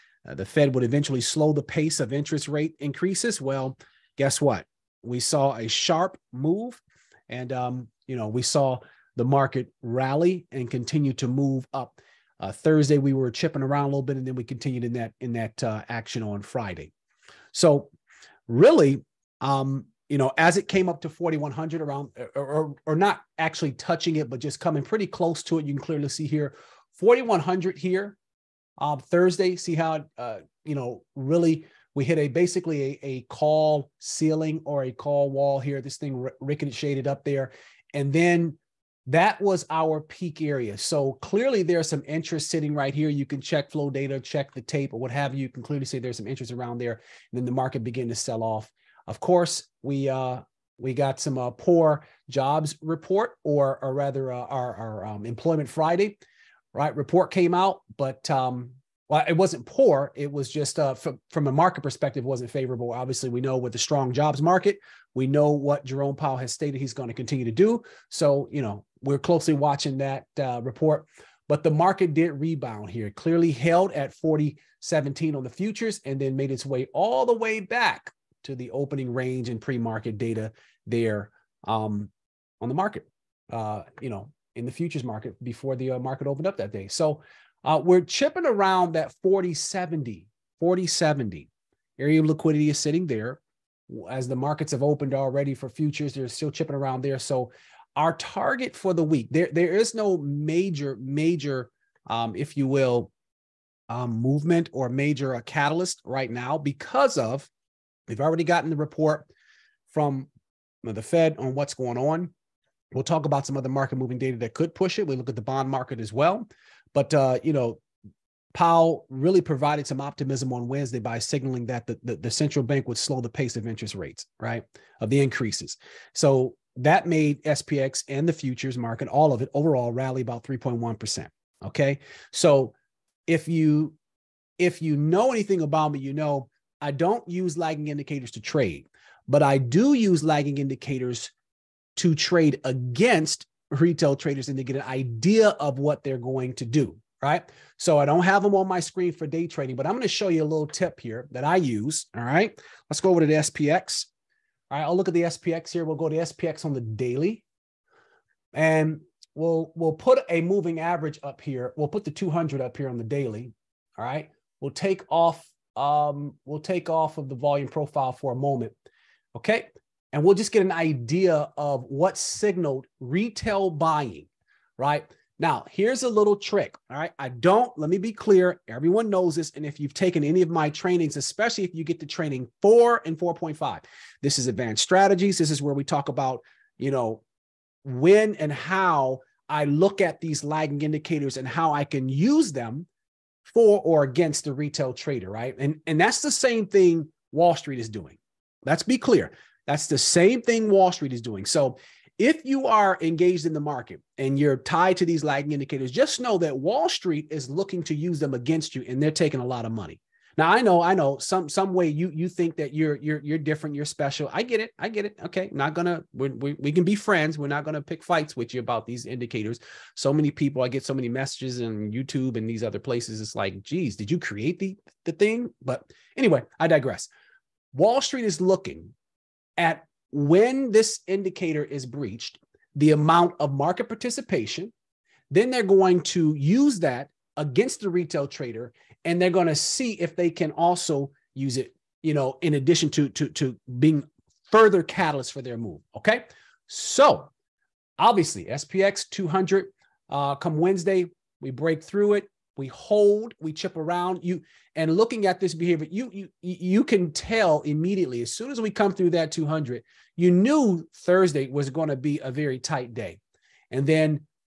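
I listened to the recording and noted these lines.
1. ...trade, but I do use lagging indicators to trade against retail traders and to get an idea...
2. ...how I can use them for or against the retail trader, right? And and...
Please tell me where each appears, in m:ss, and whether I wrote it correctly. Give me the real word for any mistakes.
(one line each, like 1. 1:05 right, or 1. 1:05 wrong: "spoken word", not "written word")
1. 2:18 right
2. 3:11 right.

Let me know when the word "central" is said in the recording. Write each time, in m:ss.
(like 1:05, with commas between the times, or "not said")
2:02.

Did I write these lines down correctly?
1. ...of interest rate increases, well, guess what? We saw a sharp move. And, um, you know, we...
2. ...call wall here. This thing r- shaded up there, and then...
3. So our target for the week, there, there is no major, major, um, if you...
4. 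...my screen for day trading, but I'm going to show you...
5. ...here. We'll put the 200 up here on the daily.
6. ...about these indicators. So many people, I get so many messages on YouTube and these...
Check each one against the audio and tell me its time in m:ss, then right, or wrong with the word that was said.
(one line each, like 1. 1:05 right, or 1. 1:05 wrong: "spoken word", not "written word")
1. 0:01 right
2. 0:34 right
3. 1:37 right
4. 2:28 right
5. 2:41 right
6. 3:38 right.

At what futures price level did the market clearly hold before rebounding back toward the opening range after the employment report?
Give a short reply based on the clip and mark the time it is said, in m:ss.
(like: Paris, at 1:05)
4017, at 1:14.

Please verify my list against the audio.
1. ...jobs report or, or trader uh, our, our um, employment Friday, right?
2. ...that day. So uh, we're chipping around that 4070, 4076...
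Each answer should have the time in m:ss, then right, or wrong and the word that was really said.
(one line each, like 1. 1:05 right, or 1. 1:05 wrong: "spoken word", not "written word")
1. 0:52 wrong: "rather", not "trader"
2. 1:26 wrong: "4070", not "4076".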